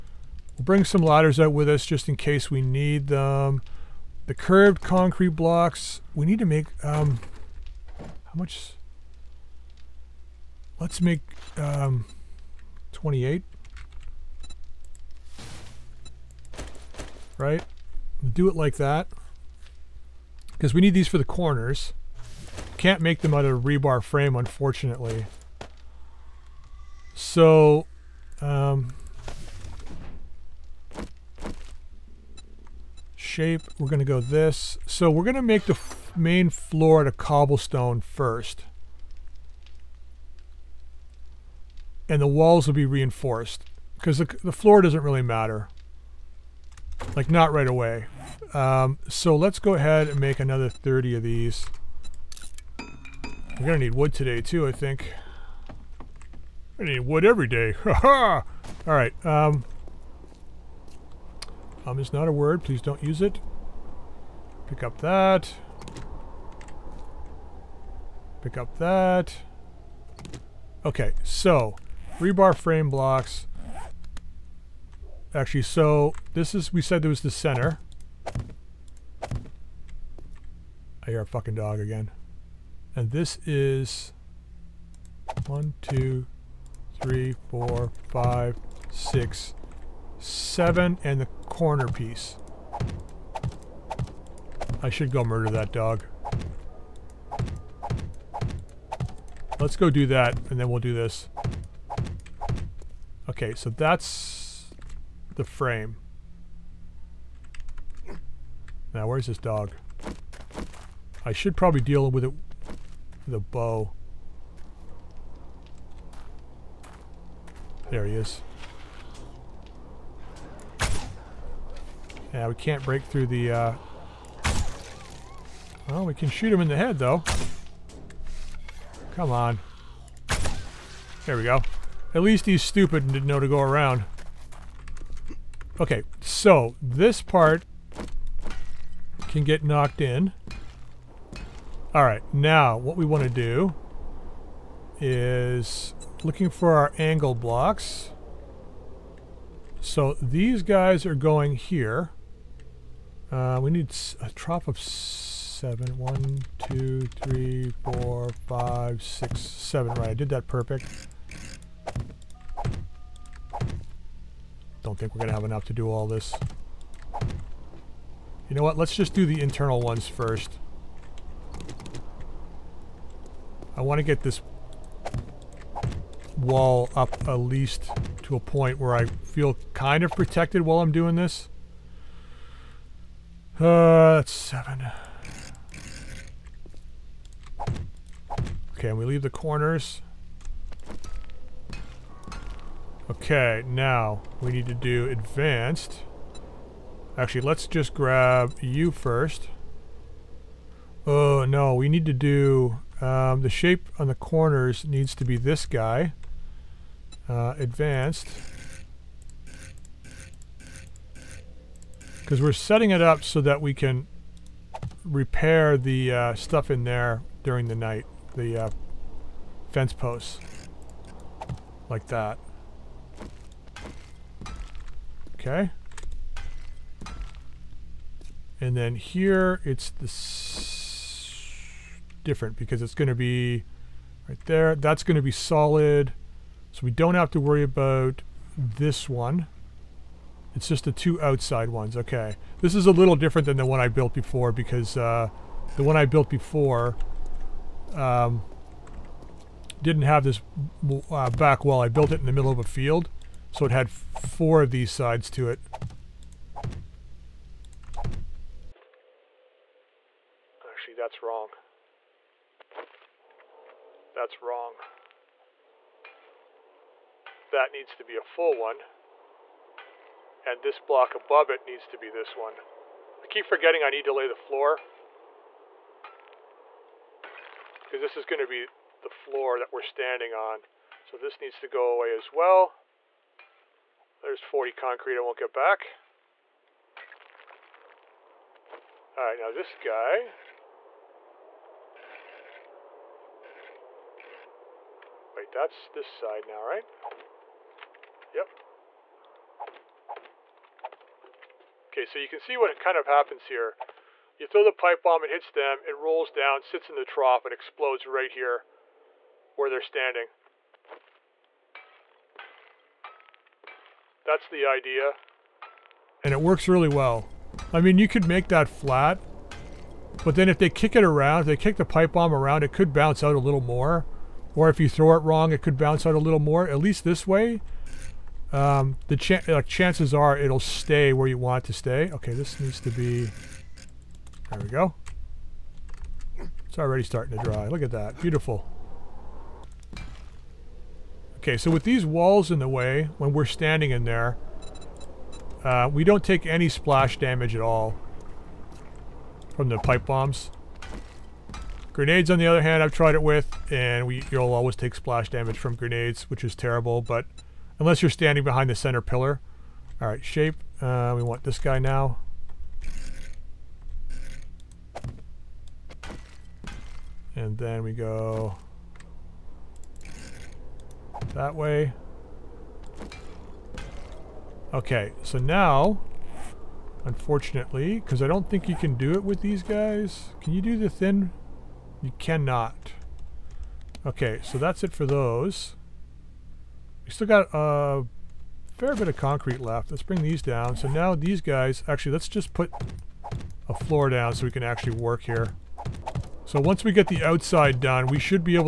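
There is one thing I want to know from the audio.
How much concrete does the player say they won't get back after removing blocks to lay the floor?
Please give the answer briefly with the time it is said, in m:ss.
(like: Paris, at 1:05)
40, at 4:44.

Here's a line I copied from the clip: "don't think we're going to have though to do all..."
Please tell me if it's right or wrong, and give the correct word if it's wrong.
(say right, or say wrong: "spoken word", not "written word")
wrong: "enough", not "though".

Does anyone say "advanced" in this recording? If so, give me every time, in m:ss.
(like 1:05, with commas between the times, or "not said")
3:15, 3:27.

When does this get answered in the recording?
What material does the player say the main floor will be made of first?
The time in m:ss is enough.
0:37.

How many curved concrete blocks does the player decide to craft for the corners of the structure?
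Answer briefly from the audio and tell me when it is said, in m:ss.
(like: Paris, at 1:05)
28, at 0:12.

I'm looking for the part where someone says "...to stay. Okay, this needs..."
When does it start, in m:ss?
5:31.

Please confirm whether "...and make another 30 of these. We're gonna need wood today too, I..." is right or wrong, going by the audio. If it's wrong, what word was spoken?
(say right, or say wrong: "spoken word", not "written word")
right.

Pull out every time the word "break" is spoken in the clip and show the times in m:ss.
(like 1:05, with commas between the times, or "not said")
2:02.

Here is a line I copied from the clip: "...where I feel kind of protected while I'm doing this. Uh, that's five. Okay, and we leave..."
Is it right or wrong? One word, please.
wrong.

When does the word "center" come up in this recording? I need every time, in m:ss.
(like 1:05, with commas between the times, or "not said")
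1:17, 5:58.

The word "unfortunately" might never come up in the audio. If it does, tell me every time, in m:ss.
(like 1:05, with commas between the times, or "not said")
0:24, 6:17.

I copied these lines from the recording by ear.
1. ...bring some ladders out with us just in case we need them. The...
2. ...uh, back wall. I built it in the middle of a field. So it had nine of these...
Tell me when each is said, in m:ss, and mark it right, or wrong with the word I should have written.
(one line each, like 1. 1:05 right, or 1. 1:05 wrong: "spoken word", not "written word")
1. 0:00 right
2. 4:11 wrong: "four", not "nine".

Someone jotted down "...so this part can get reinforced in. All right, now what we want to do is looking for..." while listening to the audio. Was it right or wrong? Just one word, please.
wrong.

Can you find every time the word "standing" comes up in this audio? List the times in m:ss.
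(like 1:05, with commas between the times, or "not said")
4:39, 5:09, 5:43, 5:58.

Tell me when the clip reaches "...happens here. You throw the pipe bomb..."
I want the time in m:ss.
5:03.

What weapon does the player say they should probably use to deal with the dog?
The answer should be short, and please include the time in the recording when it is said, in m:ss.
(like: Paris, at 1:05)
bow, at 1:53.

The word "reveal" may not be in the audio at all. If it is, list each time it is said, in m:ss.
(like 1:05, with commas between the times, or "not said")
not said.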